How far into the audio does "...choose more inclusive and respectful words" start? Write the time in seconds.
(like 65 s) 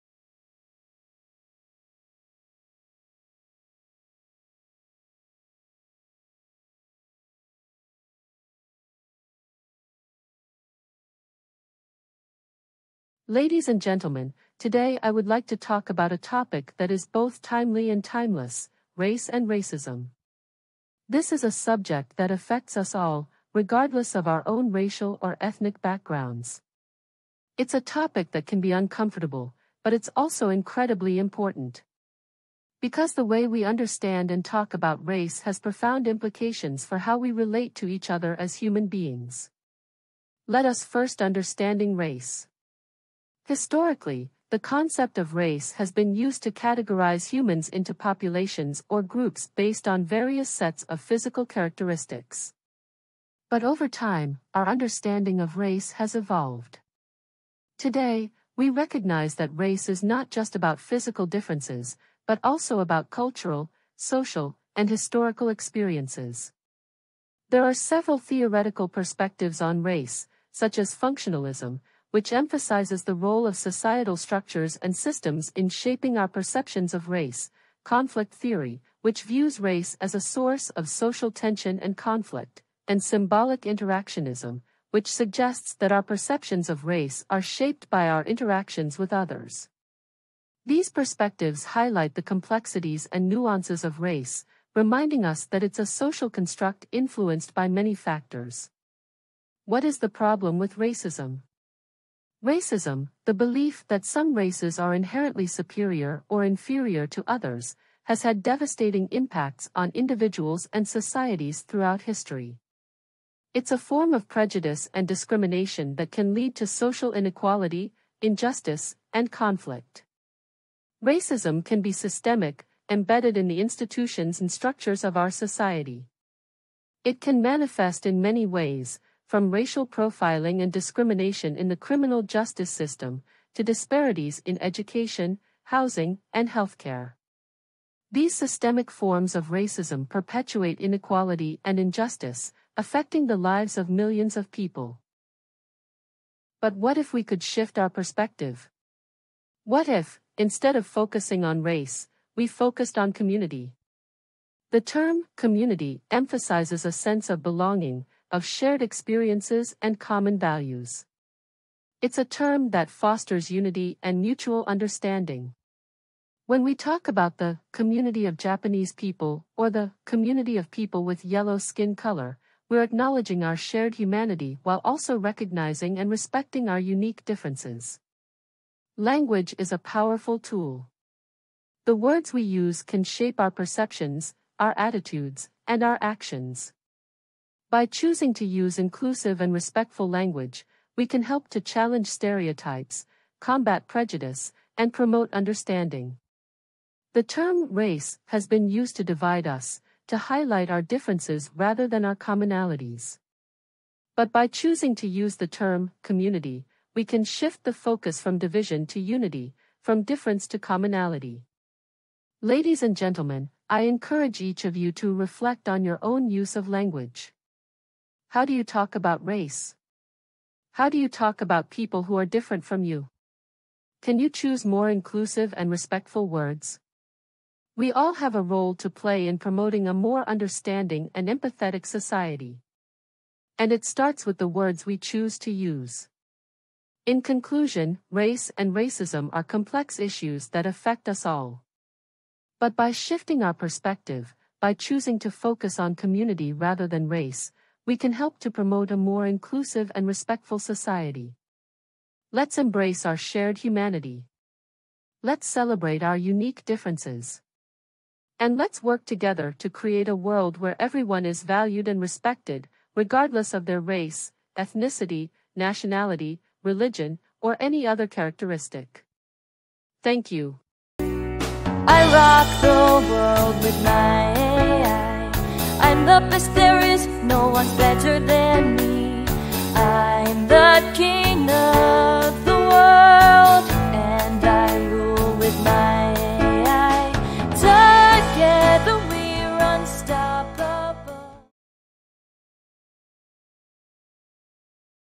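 224 s.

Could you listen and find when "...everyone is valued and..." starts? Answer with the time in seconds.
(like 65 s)
260 s.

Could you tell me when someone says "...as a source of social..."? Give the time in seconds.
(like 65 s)
80 s.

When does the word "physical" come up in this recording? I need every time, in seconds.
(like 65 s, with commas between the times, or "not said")
51 s, 60 s.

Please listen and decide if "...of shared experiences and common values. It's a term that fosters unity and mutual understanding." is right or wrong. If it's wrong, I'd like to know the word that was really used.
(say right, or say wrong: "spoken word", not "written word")
right.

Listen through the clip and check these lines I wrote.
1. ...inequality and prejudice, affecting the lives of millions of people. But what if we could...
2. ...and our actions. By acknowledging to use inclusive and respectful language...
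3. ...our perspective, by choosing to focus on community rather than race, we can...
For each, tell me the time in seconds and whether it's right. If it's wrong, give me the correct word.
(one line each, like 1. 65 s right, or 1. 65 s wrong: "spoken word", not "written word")
1. 140 s wrong: "injustice", not "prejudice"
2. 185 s wrong: "choosing", not "acknowledging"
3. 243 s right.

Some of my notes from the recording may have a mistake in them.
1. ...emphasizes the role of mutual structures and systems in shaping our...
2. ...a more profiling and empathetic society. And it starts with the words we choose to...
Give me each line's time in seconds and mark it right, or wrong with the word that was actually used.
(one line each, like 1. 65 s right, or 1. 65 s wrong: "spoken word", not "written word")
1. 72 s wrong: "societal", not "mutual"
2. 229 s wrong: "understanding", not "profiling".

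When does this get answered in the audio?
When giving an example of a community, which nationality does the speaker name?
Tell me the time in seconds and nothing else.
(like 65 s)
168 s.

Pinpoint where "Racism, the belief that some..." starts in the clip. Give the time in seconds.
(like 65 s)
102 s.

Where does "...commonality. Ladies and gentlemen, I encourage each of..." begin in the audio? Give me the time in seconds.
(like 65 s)
210 s.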